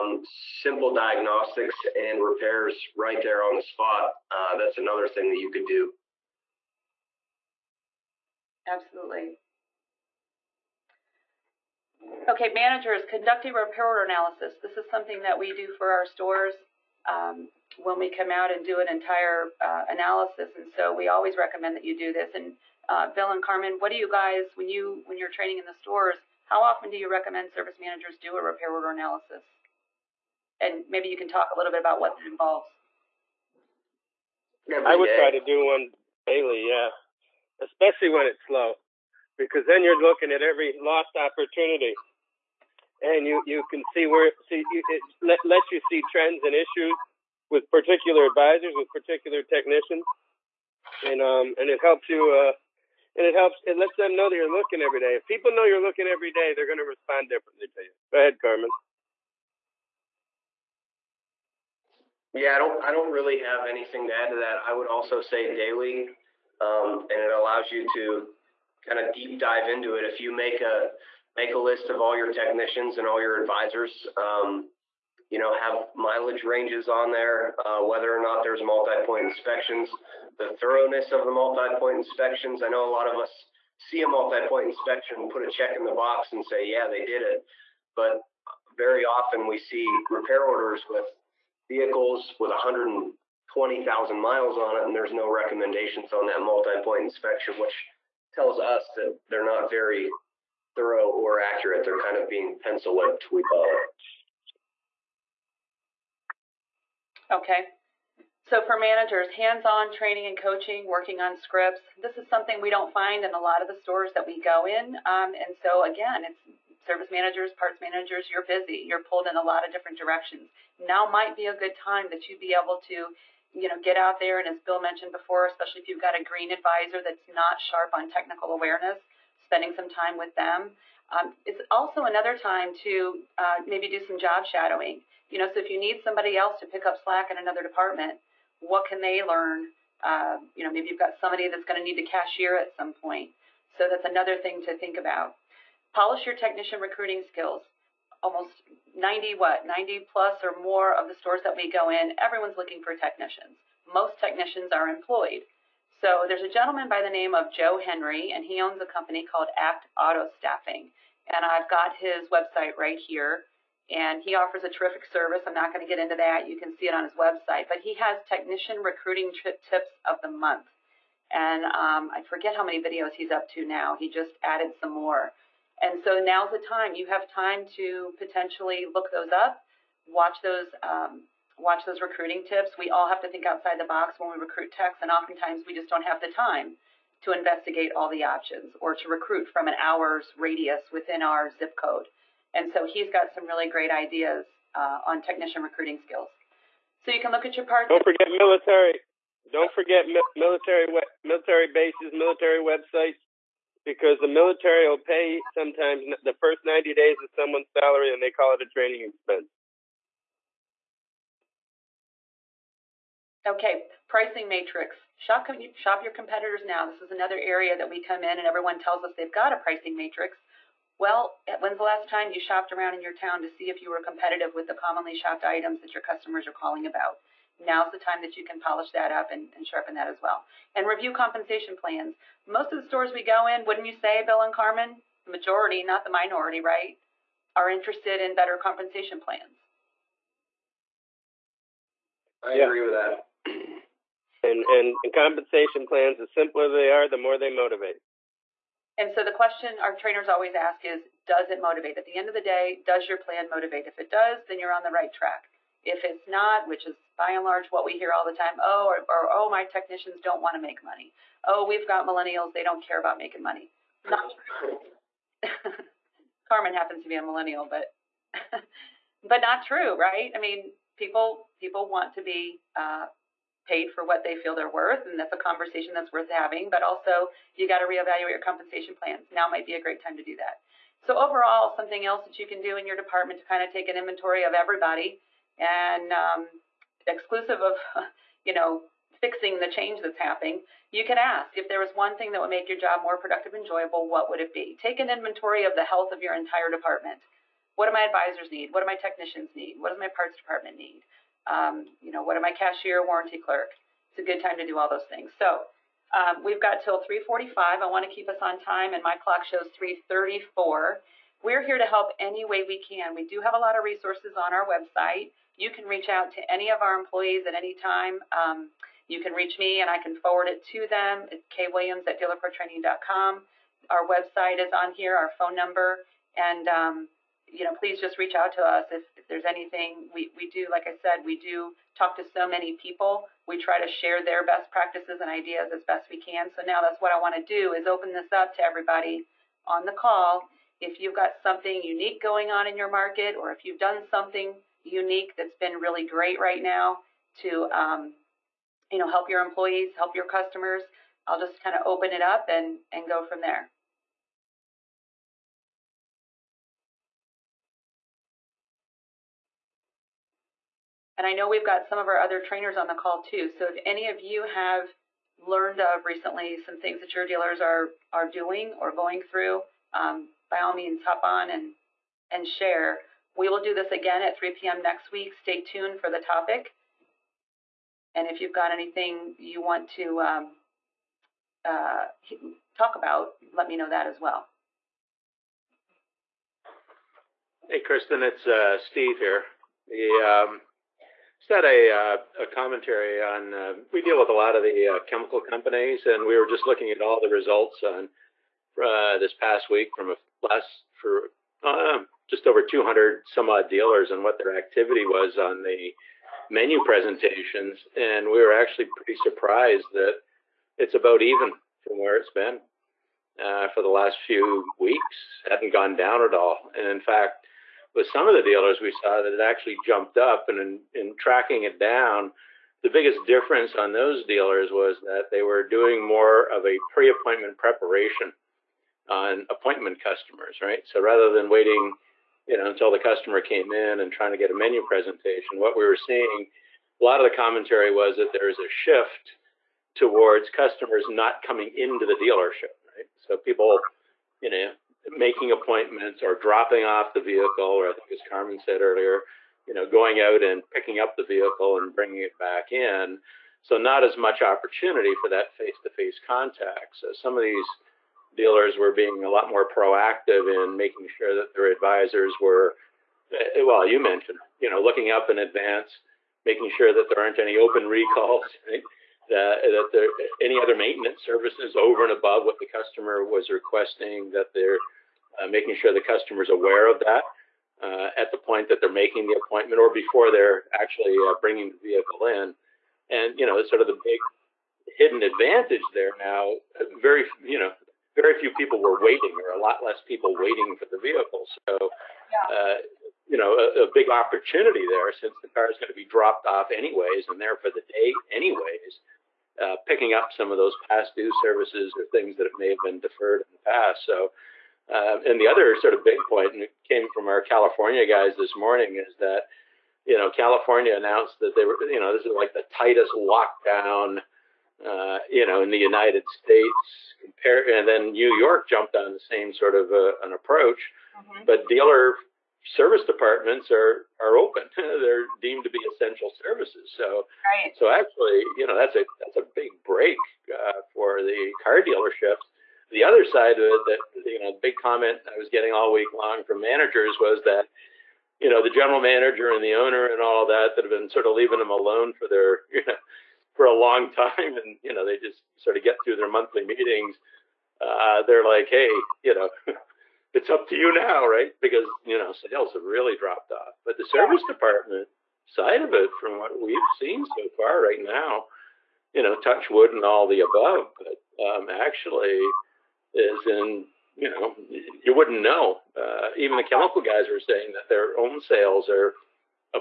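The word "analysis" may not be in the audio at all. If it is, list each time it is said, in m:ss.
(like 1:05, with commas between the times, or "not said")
0:14, 0:19, 0:28.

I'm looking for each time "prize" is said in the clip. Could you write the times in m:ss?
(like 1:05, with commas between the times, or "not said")
not said.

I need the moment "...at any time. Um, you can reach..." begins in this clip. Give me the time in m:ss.
5:17.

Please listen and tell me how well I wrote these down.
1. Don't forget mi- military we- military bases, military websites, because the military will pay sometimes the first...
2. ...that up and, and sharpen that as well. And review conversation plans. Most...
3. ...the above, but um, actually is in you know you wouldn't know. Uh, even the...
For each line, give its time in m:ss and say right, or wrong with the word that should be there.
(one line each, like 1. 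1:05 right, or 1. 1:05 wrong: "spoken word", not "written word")
1. 3:19 right
2. 3:48 wrong: "compensation", not "conversation"
3. 9:20 right.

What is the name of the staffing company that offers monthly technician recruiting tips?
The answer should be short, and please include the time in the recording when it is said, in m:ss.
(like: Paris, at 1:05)
Act Auto Staffing, at 2:39.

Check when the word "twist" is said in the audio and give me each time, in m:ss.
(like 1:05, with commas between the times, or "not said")
not said.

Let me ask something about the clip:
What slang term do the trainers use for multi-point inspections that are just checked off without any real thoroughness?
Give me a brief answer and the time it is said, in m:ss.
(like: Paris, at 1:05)
Pencil whipped, at 1:42.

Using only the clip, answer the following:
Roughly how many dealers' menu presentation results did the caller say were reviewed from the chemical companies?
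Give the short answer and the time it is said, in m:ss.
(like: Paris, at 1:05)
Just over 200, at 6:42.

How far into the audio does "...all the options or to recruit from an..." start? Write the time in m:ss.
3:07.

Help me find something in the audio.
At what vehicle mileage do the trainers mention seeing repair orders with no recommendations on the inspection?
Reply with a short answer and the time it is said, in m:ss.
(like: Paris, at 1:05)
120,000 miles, at 1:32.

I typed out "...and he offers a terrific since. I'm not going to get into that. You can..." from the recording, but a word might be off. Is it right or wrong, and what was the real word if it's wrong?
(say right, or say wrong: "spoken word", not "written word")
wrong: "service", not "since".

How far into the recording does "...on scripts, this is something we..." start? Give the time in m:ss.
1:51.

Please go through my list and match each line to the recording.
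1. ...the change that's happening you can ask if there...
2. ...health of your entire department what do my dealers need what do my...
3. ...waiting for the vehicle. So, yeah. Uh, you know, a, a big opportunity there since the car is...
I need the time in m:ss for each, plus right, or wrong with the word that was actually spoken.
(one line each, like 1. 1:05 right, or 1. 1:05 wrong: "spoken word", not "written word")
1. 4:49 right
2. 4:55 wrong: "advisors", not "dealers"
3. 8:10 right.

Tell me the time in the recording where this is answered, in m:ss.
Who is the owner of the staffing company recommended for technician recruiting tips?
2:37.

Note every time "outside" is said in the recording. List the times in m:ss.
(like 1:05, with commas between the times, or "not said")
3:03.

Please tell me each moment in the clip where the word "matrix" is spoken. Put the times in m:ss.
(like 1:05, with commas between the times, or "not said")
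3:34, 3:39.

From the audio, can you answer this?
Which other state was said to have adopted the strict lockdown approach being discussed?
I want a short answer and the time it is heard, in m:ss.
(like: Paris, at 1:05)
New York, at 8:38.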